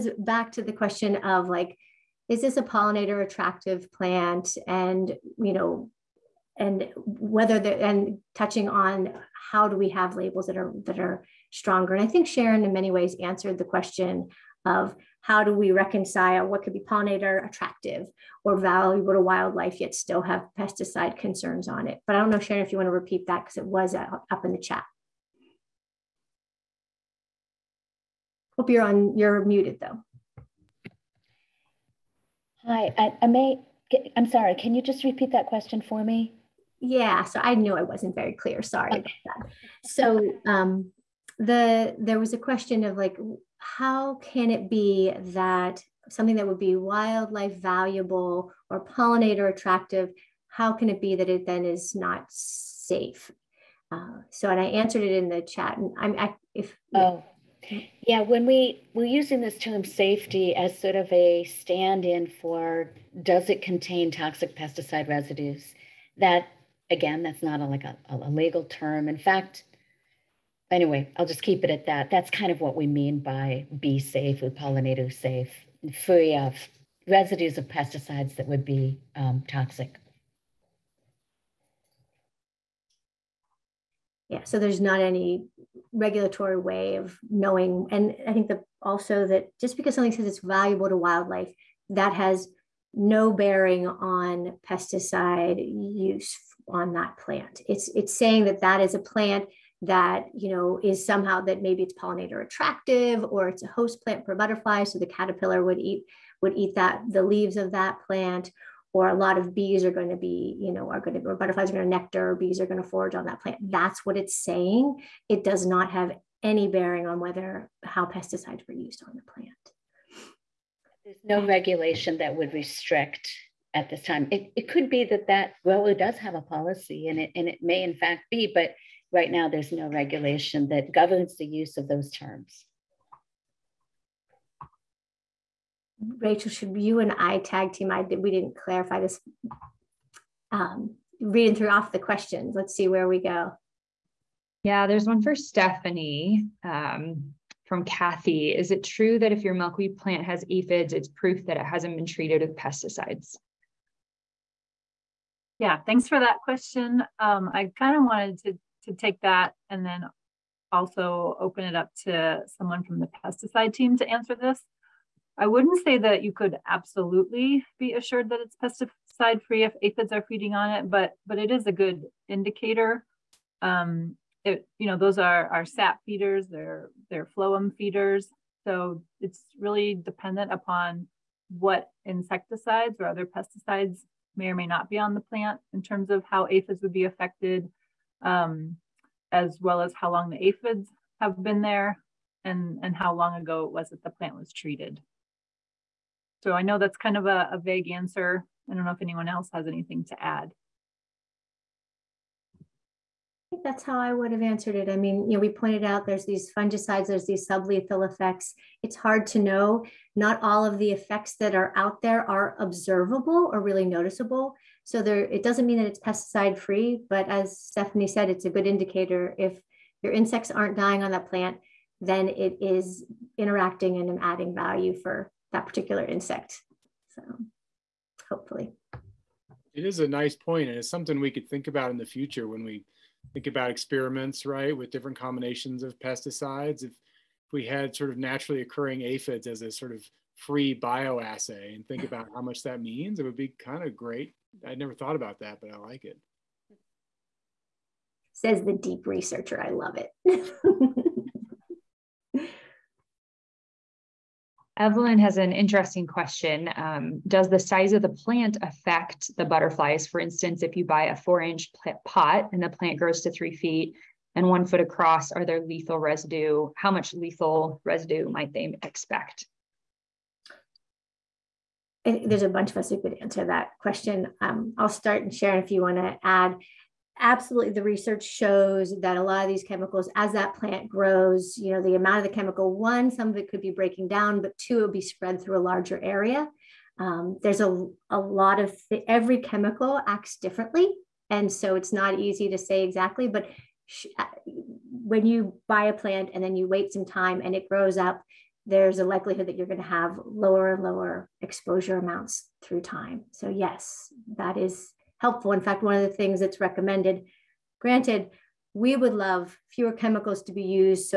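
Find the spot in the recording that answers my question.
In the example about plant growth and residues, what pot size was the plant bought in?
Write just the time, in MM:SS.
04:21.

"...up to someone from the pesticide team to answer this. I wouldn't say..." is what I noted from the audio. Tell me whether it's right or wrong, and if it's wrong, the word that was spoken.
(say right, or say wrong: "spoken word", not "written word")
right.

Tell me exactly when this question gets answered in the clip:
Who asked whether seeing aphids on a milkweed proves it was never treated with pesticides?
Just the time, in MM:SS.
02:27.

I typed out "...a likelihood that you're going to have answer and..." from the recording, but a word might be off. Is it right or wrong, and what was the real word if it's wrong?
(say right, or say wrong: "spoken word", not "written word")
wrong: "lower", not "answer".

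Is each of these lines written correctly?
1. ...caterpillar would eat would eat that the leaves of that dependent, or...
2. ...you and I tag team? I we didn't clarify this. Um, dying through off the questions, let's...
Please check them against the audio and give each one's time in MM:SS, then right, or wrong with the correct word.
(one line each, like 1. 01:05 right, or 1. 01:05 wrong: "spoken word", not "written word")
1. 01:45 wrong: "plant", not "dependent"
2. 02:16 wrong: "reading", not "dying".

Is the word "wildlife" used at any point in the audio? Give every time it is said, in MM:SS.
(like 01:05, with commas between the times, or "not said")
00:19, 00:46, 01:30.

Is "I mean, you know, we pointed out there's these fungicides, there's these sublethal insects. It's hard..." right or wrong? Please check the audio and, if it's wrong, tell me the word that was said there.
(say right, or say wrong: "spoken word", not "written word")
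wrong: "effects", not "insects".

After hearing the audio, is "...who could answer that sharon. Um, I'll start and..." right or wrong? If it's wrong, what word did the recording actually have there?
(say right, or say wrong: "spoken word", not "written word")
wrong: "question", not "sharon".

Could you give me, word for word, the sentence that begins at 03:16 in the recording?
So I know that's kind of a, a vague answer.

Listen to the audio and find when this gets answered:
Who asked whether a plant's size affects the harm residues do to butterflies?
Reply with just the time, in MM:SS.
04:14.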